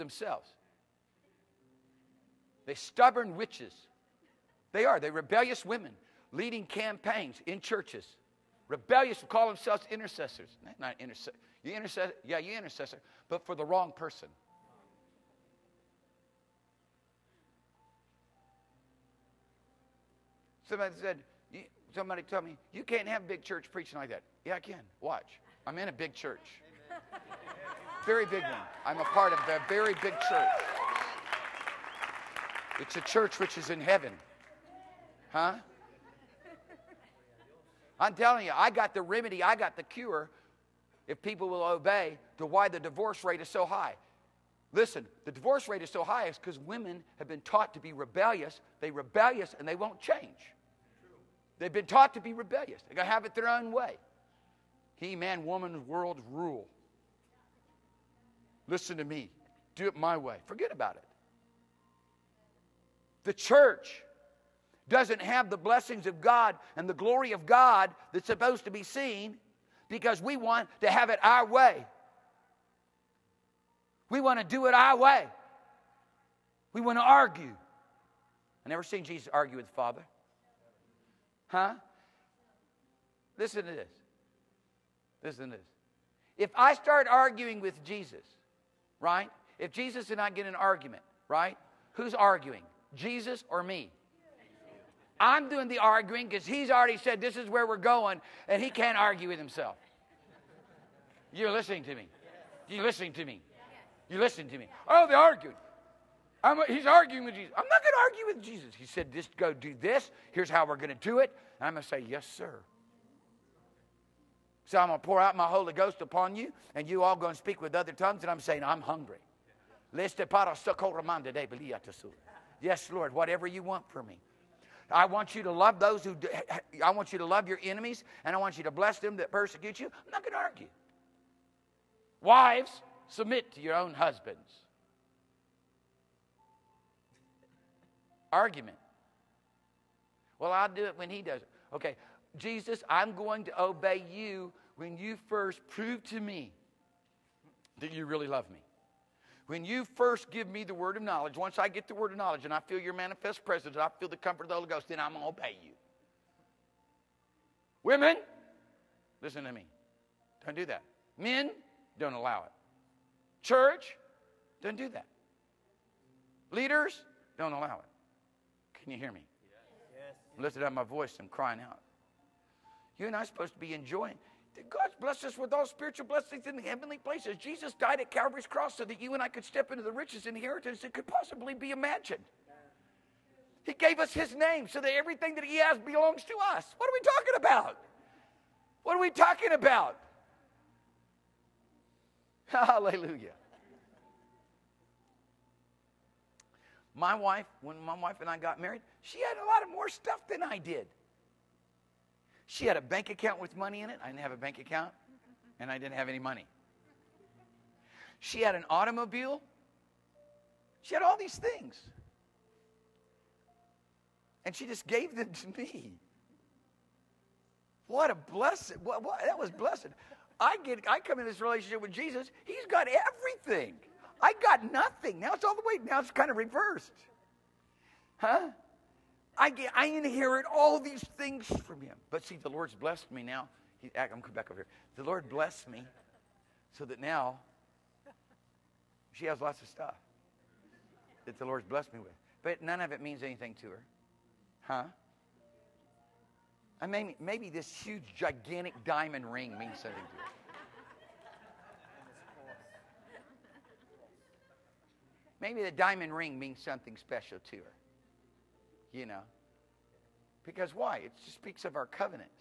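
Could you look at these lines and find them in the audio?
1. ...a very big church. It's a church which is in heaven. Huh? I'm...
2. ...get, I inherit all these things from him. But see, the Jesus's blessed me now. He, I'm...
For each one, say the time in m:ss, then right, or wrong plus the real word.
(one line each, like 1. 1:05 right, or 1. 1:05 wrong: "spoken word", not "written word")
1. 0:29 right
2. 3:49 wrong: "Lord", not "Jesus".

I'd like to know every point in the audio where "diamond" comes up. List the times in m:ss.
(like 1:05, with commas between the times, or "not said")
4:08, 4:15.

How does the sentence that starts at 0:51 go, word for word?
They've been taught to be rebellious.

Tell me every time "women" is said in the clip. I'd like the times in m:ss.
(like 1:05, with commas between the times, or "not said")
0:05, 0:46, 2:37.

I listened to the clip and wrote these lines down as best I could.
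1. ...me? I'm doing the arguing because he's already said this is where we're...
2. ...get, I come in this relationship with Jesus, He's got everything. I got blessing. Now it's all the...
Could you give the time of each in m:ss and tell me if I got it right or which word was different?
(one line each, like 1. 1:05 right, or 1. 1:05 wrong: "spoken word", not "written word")
1. 1:33 right
2. 3:40 wrong: "nothing", not "blessing".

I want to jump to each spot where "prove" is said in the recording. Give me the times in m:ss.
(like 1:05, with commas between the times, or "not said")
2:25.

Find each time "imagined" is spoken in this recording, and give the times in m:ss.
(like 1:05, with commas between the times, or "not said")
3:01.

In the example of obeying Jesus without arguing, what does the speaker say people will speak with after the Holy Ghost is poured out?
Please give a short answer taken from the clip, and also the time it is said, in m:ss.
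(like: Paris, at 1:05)
Other tongues, at 1:57.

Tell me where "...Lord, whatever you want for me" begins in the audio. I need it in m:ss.
2:02.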